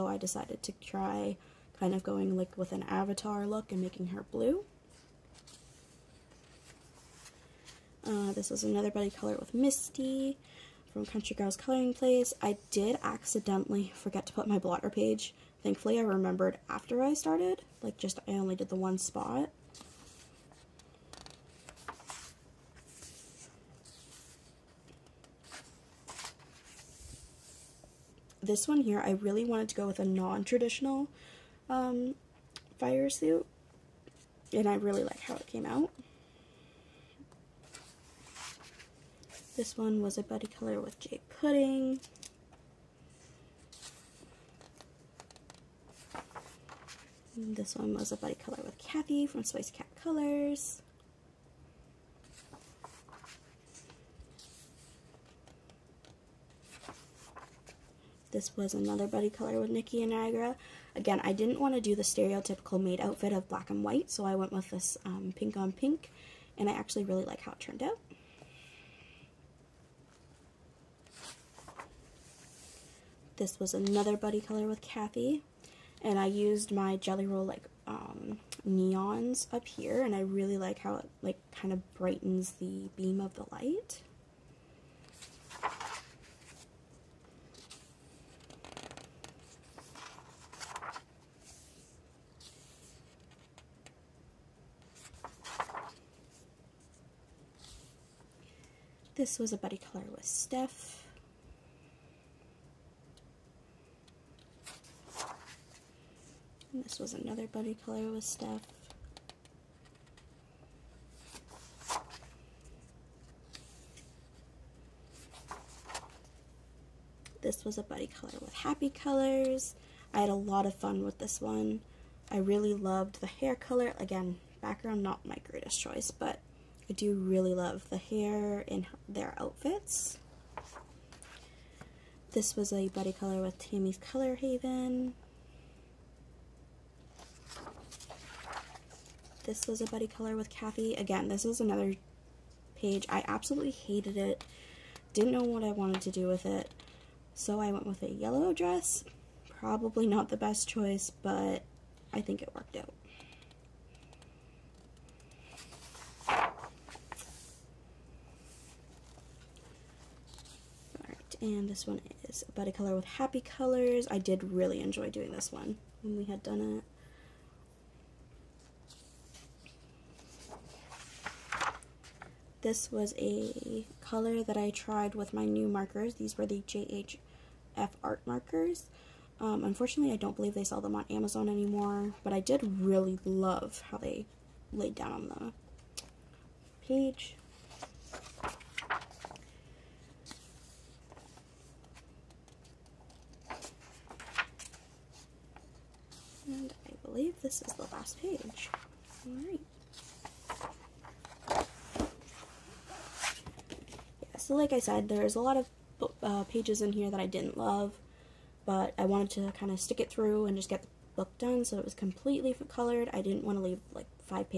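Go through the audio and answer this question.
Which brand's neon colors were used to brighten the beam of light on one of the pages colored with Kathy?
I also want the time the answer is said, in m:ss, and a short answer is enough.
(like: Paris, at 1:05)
Jelly Roll, at 1:16.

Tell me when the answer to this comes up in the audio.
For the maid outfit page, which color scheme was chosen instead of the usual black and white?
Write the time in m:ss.
1:05.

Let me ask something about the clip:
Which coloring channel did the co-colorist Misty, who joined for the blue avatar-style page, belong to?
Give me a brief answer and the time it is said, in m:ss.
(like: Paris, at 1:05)
Country Girls Coloring Place, at 0:11.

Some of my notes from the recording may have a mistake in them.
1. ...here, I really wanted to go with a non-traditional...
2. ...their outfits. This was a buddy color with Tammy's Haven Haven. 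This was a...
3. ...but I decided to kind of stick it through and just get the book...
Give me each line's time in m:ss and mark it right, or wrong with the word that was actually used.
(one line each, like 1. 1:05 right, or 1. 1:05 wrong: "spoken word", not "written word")
1. 0:28 right
2. 2:09 wrong: "Color", not "Haven"
3. 3:28 wrong: "wanted", not "decided".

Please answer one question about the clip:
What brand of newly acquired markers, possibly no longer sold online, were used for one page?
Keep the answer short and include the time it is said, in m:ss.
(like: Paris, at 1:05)
JHF art markers, at 2:56.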